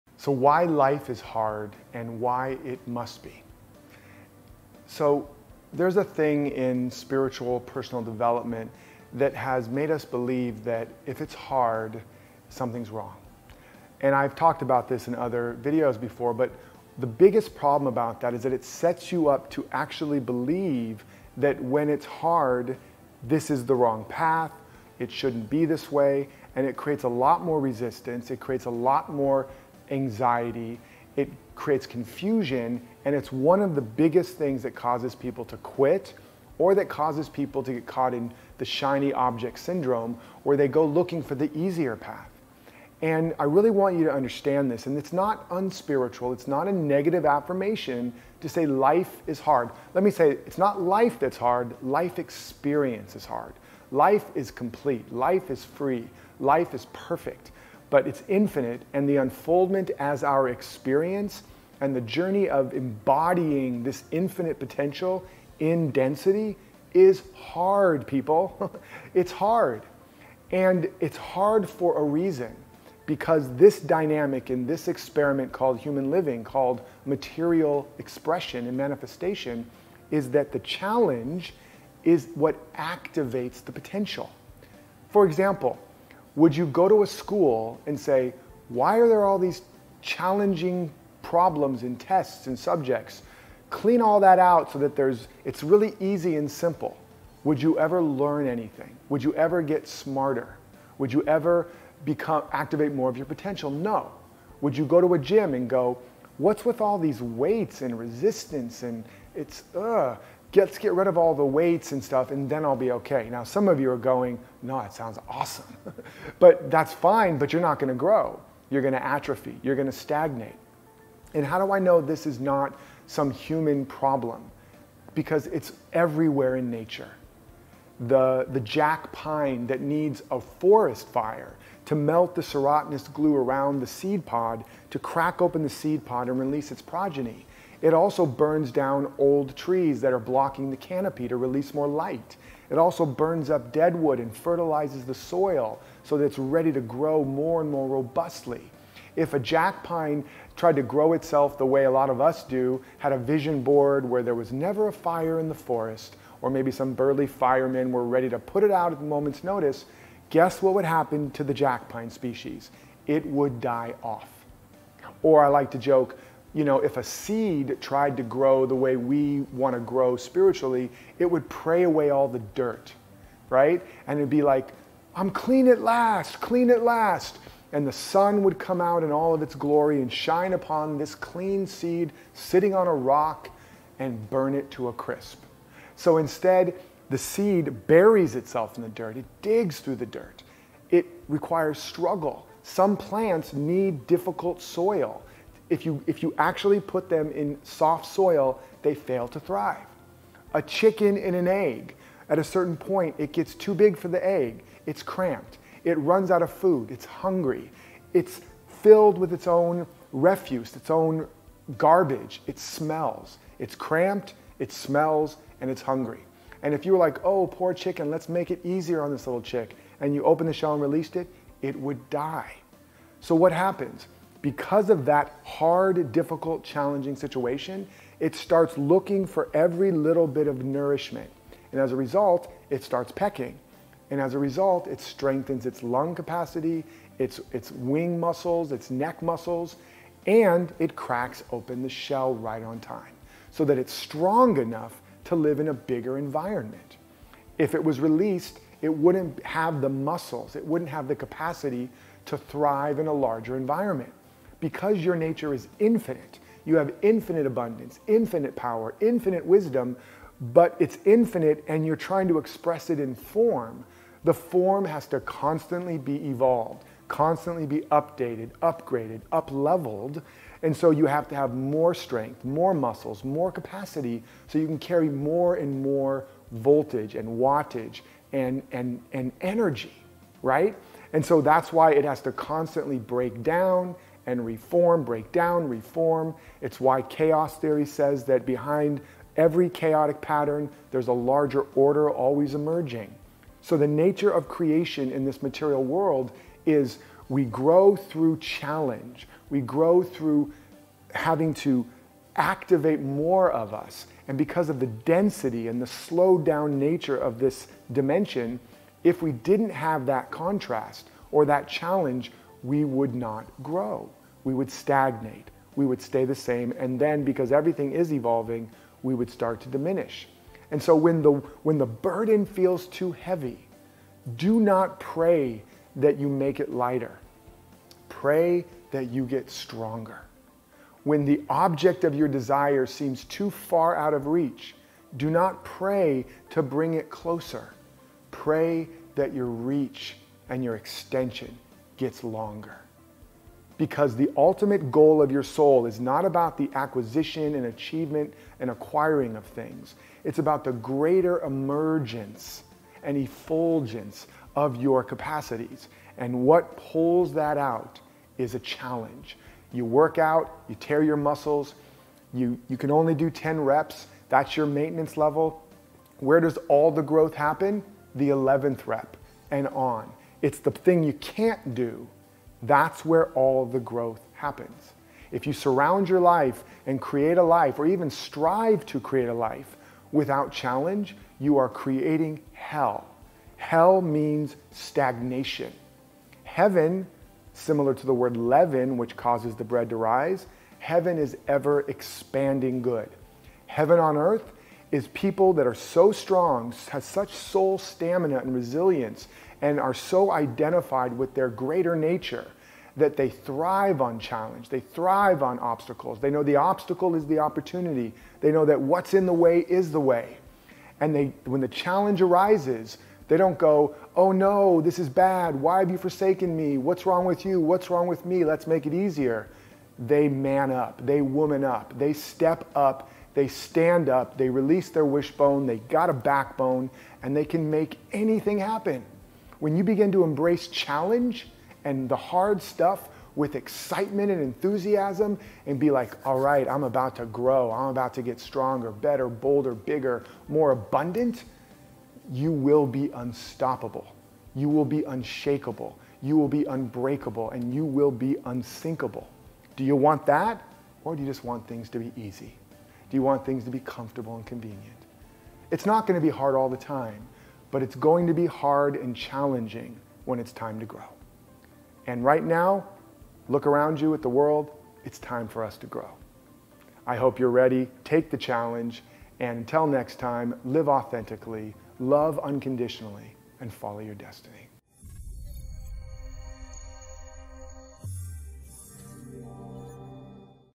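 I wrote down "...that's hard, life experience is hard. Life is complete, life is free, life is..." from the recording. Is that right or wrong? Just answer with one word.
right.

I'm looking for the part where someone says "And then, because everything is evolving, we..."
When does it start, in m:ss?
5:16.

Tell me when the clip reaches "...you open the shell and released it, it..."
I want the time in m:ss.
3:40.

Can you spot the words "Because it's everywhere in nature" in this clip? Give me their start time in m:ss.
2:05.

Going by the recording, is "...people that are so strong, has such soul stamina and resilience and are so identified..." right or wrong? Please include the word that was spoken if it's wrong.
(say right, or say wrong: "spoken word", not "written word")
right.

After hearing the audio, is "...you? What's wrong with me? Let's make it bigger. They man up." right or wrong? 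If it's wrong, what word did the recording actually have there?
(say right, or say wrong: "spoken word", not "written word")
wrong: "easier", not "bigger".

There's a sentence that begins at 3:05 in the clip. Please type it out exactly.
So instead, the seed buries itself in the dirt, it digs through the dirt.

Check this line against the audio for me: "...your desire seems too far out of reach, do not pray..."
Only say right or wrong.
right.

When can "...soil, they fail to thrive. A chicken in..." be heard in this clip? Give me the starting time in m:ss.
3:18.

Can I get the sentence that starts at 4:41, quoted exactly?
And so that's why it has to constantly break down, and reform, break down, reform.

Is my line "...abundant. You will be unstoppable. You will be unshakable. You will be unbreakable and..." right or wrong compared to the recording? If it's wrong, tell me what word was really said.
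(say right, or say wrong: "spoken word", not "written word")
right.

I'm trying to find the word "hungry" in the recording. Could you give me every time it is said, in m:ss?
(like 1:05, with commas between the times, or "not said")
3:27, 3:35.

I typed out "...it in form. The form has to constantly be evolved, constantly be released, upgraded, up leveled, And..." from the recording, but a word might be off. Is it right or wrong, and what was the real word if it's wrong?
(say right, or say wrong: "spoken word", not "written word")
wrong: "updated", not "released".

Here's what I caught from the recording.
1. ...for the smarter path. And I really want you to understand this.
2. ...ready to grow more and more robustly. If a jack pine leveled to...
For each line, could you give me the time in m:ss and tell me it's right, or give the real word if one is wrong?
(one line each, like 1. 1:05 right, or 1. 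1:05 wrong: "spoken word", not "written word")
1. 0:41 wrong: "easier", not "smarter"
2. 2:26 wrong: "tried", not "leveled".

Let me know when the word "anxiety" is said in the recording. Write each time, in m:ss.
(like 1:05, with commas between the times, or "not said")
0:29.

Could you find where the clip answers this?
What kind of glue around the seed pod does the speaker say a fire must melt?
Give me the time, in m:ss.
2:12.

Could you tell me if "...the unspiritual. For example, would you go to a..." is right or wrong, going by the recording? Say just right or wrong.
wrong.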